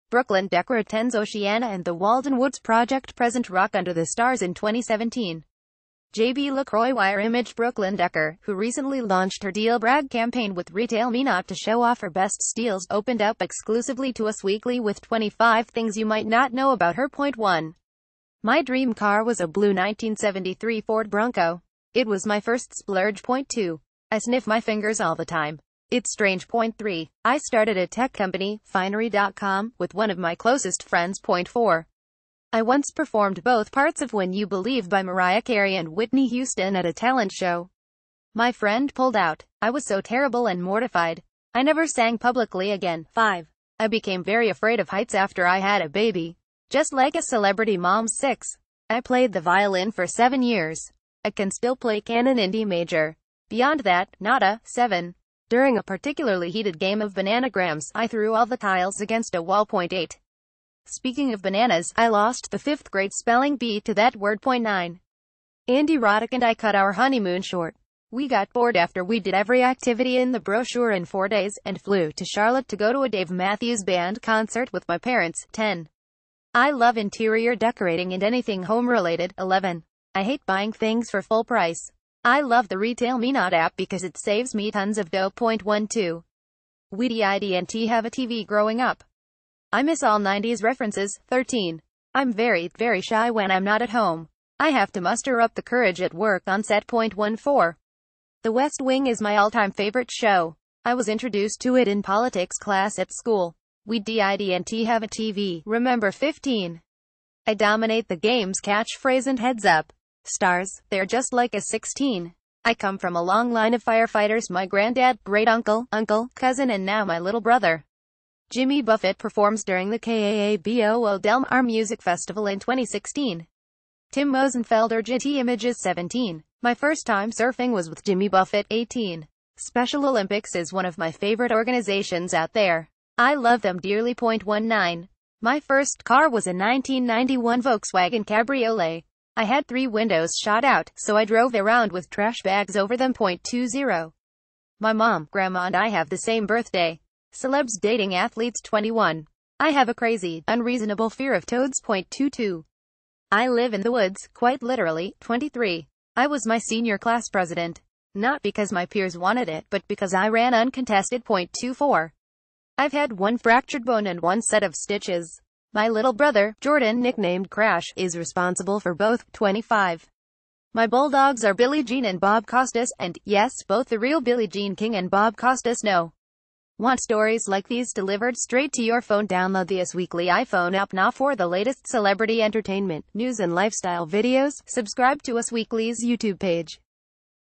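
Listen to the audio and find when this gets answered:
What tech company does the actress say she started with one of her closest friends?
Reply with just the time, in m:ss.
0:28.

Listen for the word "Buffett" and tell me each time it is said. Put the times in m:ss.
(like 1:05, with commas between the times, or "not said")
1:58, 2:08.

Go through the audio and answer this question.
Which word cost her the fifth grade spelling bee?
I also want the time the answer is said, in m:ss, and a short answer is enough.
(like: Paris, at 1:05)
bananas, at 1:01.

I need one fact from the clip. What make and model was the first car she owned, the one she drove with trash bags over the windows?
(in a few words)
Volkswagen Cabriolet.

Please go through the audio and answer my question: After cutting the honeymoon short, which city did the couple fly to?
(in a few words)
Charlotte.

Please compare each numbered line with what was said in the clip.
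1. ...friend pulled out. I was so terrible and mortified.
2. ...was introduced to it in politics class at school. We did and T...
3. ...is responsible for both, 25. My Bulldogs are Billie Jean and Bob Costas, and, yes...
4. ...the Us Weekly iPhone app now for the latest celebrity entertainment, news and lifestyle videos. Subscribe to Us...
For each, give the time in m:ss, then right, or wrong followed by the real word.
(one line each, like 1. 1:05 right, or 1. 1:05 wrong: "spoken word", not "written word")
1. 0:38 right
2. 1:40 right
3. 2:47 right
4. 2:59 right.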